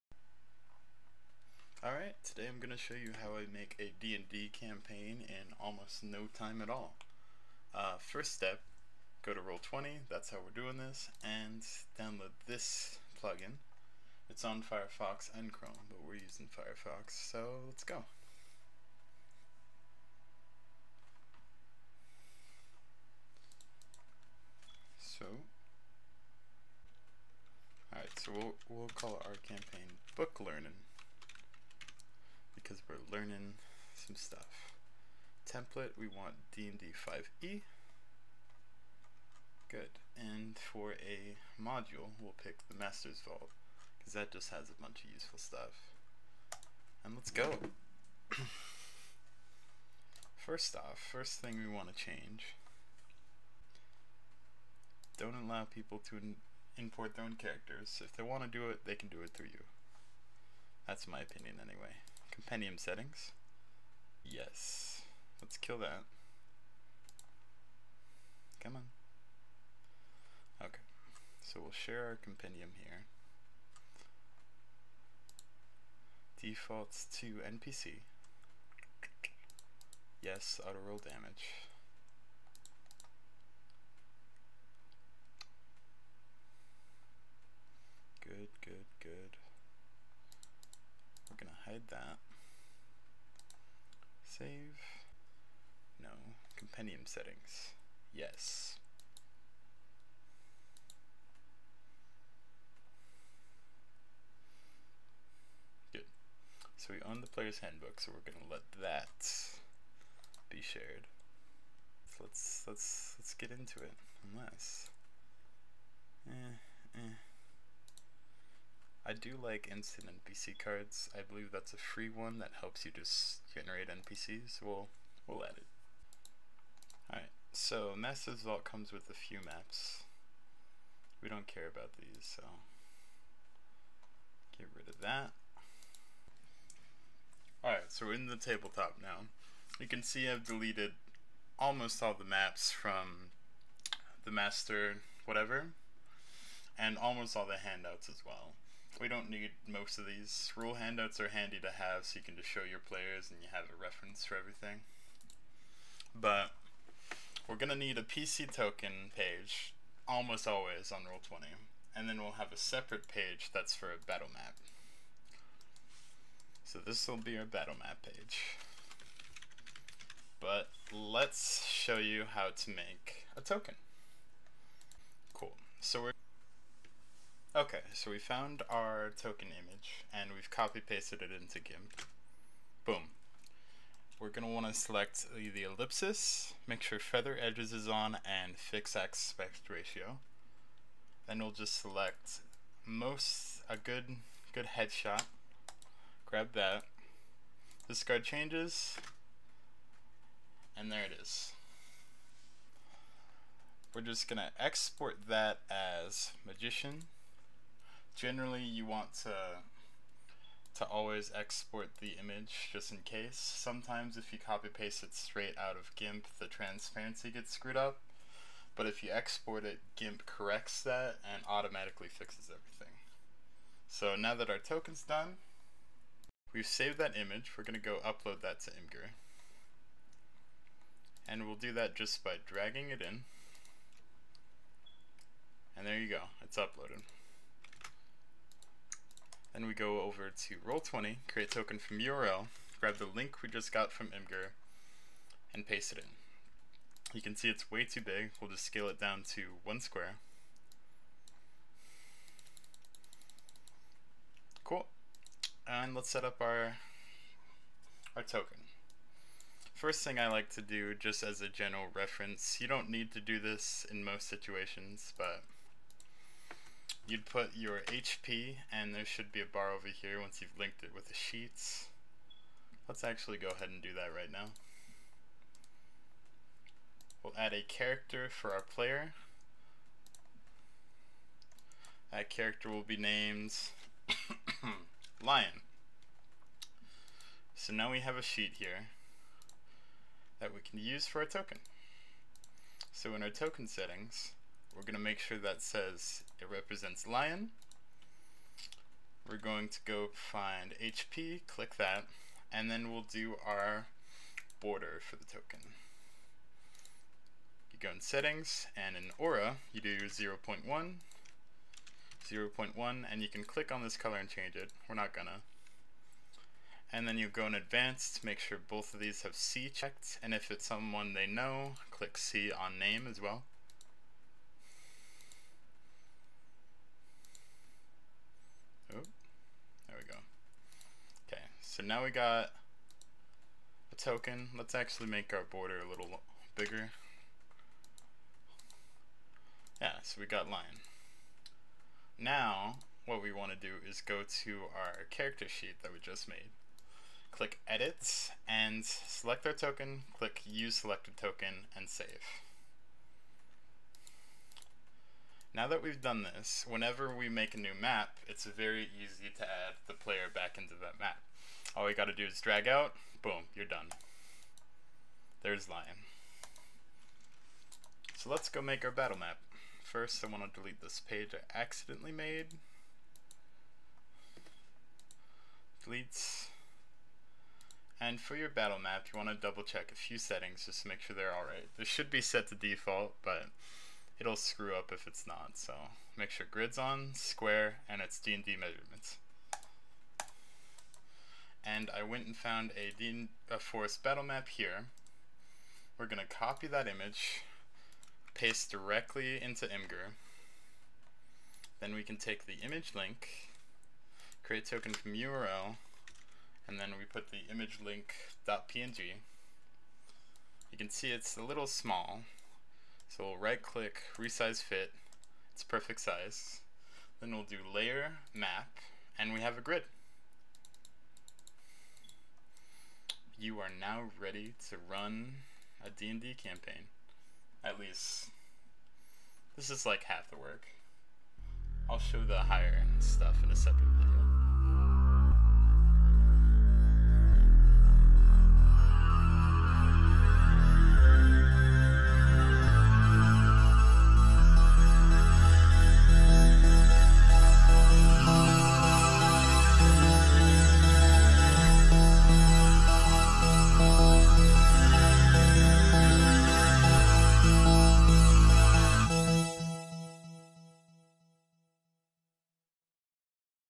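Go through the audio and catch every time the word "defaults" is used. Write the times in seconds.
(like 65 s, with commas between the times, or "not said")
76 s, 382 s.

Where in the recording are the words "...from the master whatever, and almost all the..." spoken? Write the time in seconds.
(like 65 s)
142 s.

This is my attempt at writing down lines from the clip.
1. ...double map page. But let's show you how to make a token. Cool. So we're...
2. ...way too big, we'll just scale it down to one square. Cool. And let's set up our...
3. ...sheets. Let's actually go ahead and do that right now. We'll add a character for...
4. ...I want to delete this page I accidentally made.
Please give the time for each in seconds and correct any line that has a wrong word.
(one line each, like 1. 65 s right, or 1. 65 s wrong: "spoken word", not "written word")
1. 167 s wrong: "battle", not "double"
2. 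247 s right
3. 271 s right
4. 370 s right.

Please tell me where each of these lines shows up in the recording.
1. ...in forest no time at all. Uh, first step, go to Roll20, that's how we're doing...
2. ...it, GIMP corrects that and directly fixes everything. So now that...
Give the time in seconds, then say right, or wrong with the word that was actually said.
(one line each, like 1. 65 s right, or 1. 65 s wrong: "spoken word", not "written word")
1. 5 s wrong: "almost", not "forest"
2. 219 s wrong: "automatically", not "directly".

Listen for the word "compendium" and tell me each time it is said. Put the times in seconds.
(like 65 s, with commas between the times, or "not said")
62 s, 72 s, 96 s.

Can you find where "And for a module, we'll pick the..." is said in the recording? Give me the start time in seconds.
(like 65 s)
40 s.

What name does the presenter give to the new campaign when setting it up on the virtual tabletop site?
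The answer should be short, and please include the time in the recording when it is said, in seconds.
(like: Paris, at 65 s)
Book Learning, at 30 s.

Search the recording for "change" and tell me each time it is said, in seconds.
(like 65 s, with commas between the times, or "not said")
51 s, 198 s, 314 s.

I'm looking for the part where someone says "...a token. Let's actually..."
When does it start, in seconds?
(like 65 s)
333 s.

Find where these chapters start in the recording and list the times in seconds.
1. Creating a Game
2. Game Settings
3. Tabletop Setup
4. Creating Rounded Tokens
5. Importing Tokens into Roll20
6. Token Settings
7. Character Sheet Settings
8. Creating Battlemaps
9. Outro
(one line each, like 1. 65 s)
1. 18 s
2. 50 s
3. 127 s
4. 180 s
5. 225 s
6. 255 s
7. 345 s
8. 366 s
9. 435 s.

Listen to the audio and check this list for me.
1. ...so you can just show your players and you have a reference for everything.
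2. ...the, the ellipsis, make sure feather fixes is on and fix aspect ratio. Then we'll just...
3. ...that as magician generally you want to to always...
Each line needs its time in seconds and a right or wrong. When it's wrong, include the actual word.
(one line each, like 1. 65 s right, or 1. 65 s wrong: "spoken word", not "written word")
1. 152 s right
2. 185 s wrong: "edges", not "fixes"
3. 205 s right.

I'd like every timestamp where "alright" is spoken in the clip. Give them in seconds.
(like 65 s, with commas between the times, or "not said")
1 s, 27 s, 127 s, 137 s, 381 s.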